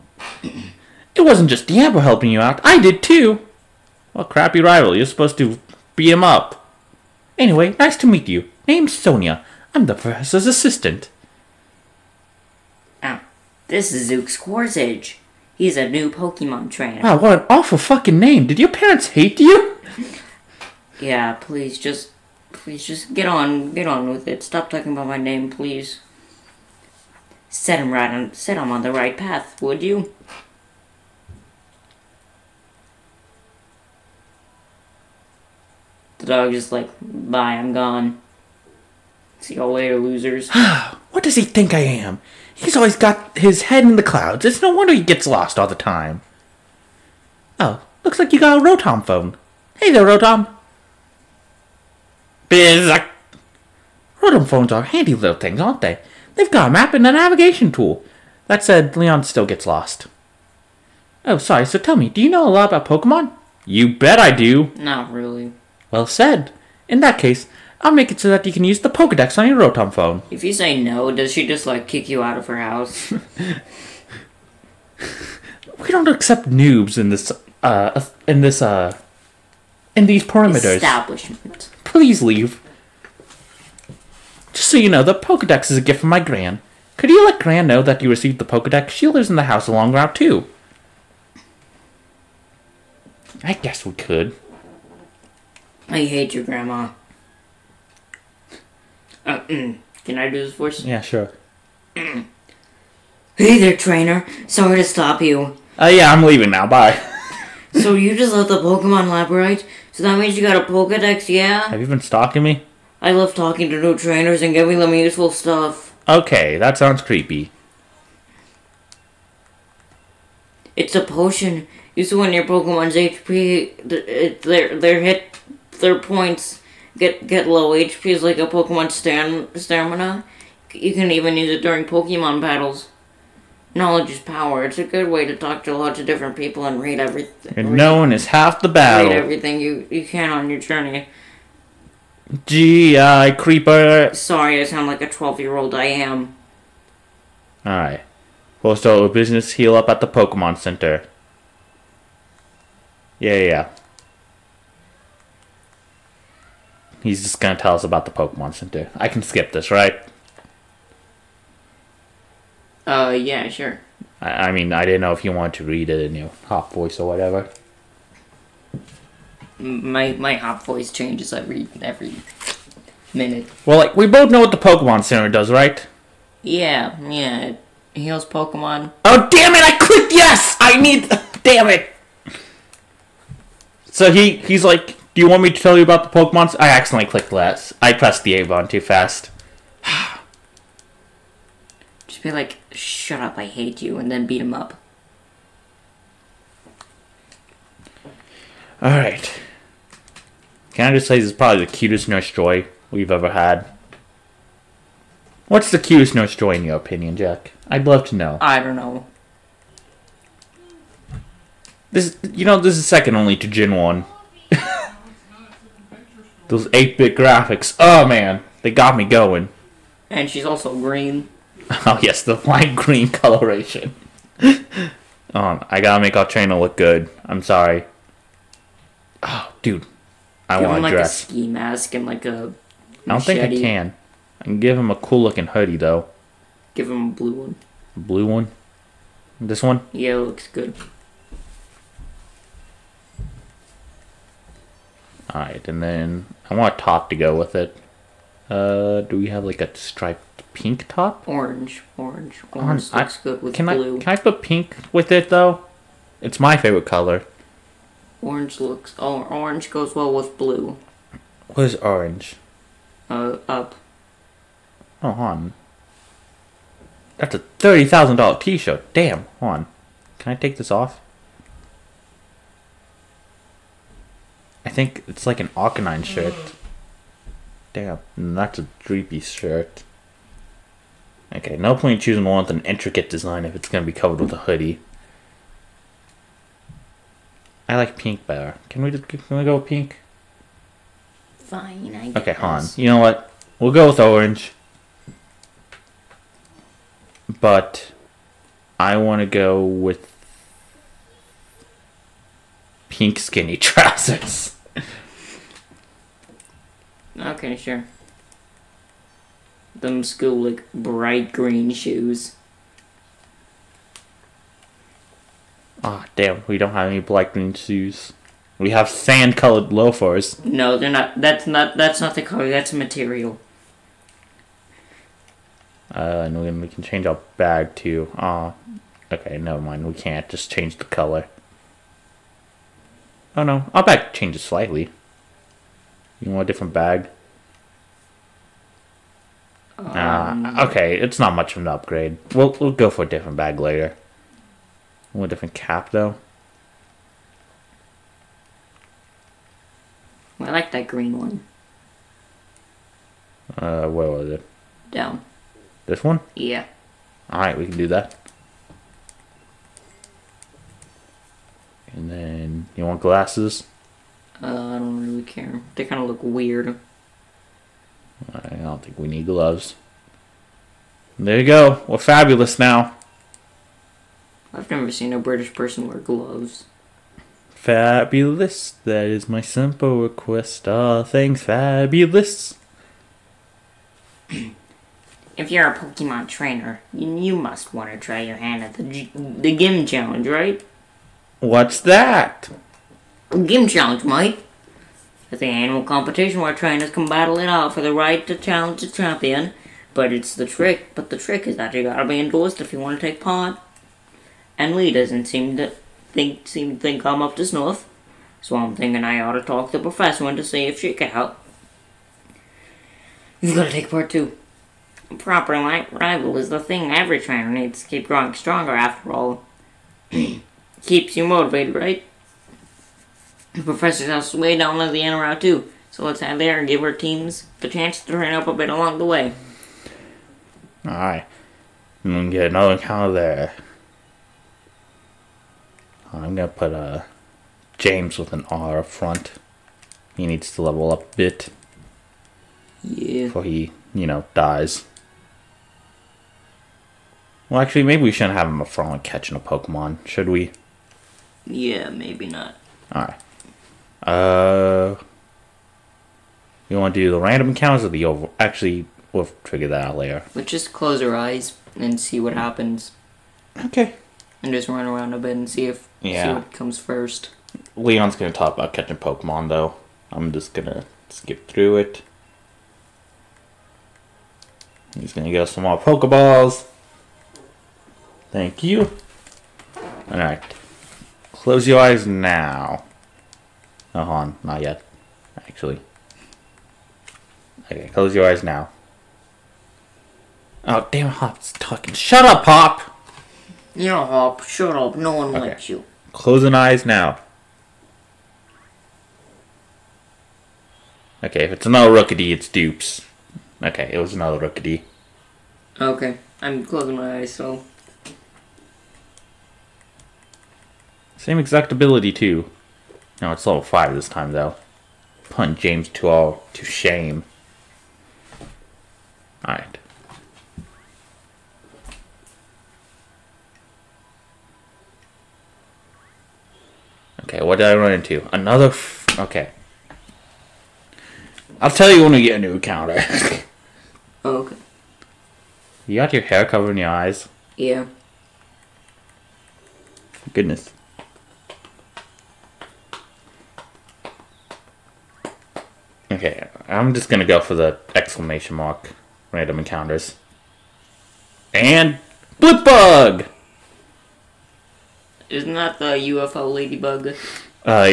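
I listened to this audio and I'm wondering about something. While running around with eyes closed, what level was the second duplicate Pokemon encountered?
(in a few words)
5.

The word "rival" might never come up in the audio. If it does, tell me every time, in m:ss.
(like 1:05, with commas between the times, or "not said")
0:04, 6:55.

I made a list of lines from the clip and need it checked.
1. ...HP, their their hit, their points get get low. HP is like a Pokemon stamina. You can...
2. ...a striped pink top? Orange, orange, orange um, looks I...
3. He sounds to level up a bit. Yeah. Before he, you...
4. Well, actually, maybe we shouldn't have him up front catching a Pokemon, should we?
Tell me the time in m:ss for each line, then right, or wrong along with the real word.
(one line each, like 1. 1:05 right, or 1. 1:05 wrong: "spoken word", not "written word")
1. 2:02 right
2. 4:09 right
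3. 7:20 wrong: "needs", not "sounds"
4. 7:27 right.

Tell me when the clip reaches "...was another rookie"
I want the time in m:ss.
8:23.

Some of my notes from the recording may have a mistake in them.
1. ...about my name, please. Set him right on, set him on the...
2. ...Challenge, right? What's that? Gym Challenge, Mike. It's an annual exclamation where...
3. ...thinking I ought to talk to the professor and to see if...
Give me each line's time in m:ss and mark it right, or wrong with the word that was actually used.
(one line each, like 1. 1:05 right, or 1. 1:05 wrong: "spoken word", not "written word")
1. 0:24 right
2. 6:29 wrong: "competition", not "exclamation"
3. 6:48 right.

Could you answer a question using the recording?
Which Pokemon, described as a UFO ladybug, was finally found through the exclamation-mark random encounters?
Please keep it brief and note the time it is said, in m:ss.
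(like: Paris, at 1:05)
Blipbug, at 9:12.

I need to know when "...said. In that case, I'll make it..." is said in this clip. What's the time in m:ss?
1:06.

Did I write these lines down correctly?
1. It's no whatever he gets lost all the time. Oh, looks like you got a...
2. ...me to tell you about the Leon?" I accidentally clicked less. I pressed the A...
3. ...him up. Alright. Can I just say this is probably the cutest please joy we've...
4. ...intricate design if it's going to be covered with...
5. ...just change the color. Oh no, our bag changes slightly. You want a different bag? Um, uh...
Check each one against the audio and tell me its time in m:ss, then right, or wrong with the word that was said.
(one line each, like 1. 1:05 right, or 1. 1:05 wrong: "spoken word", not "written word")
1. 0:44 wrong: "wonder", not "whatever"
2. 3:05 wrong: "Pokemon", not "Leon"
3. 3:14 wrong: "nurse", not "please"
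4. 4:42 right
5. 5:30 right.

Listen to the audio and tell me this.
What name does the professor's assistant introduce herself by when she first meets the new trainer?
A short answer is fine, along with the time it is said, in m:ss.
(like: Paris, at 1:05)
Sonia, at 0:08.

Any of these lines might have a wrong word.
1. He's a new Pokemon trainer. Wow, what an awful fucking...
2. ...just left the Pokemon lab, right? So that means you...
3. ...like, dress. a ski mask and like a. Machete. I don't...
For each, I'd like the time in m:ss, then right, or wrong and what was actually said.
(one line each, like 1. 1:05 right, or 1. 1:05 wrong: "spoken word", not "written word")
1. 0:15 right
2. 1:48 right
3. 3:50 right.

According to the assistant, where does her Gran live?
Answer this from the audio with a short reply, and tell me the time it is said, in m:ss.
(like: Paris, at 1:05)
Route 2, at 1:29.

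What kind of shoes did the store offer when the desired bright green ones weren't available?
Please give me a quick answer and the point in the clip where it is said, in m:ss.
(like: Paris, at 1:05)
Sand colored loafers, at 5:18.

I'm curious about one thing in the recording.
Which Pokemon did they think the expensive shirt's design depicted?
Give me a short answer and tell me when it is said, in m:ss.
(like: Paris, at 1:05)
Arcanine, at 4:35.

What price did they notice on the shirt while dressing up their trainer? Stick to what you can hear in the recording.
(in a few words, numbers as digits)
$30,000.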